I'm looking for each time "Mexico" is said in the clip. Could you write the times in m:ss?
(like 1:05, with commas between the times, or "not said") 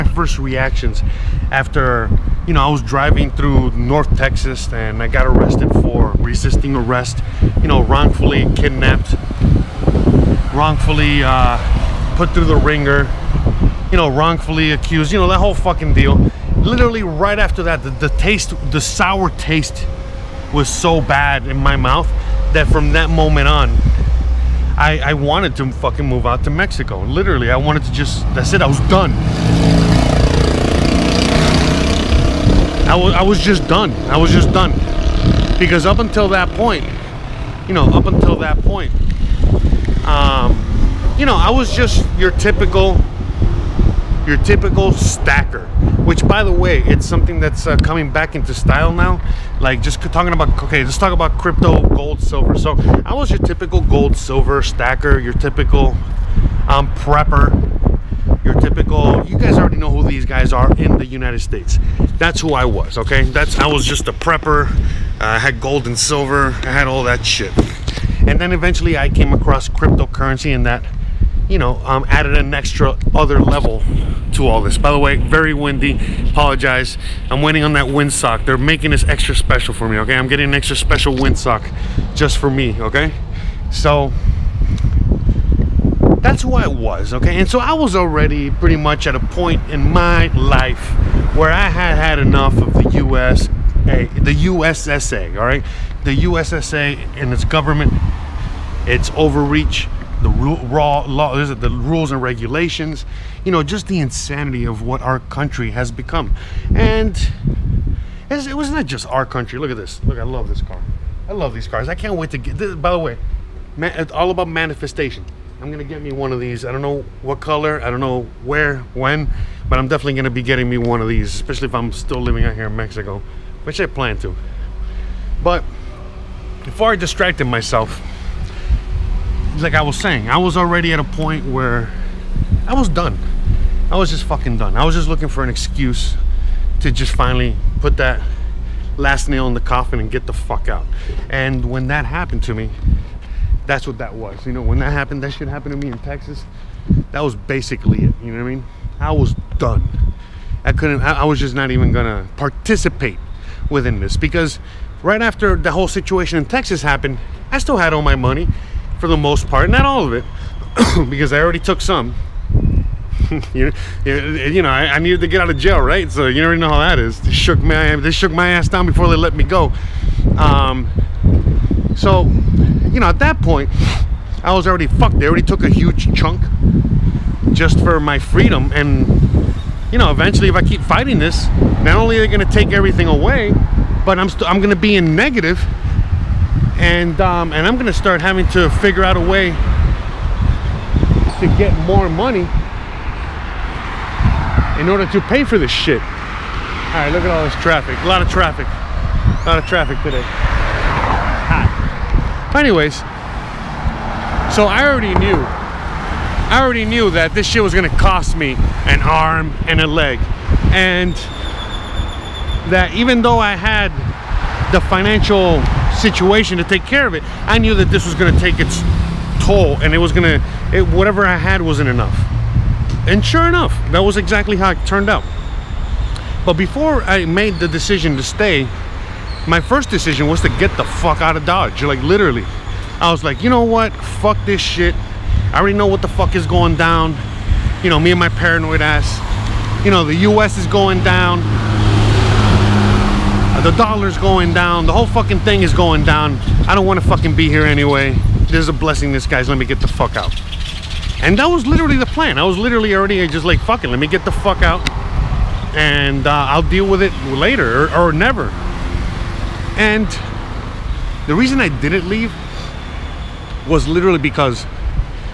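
0:26, 2:02.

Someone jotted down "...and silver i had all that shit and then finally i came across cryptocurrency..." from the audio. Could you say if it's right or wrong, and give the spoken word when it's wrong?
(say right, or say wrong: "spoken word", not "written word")
wrong: "eventually", not "finally".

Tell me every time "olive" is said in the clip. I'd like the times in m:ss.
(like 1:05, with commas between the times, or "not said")
not said.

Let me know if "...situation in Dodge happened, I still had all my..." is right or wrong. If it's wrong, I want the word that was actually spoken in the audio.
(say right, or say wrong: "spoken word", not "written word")
wrong: "Texas", not "Dodge".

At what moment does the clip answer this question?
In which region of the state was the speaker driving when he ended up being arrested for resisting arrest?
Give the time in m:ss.
0:03.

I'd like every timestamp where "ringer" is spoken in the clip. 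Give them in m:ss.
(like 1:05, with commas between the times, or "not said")
0:12.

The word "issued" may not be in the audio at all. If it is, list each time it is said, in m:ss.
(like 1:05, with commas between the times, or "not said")
not said.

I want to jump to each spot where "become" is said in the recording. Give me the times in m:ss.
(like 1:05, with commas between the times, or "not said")
1:45.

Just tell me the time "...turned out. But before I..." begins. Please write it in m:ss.
3:44.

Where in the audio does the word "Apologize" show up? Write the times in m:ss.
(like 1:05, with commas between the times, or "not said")
1:16.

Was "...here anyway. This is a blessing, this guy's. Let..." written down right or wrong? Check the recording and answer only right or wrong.
right.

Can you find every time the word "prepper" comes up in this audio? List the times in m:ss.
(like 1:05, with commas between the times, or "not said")
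0:56, 1:04.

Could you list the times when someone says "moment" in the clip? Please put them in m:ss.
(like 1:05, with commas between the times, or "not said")
0:23.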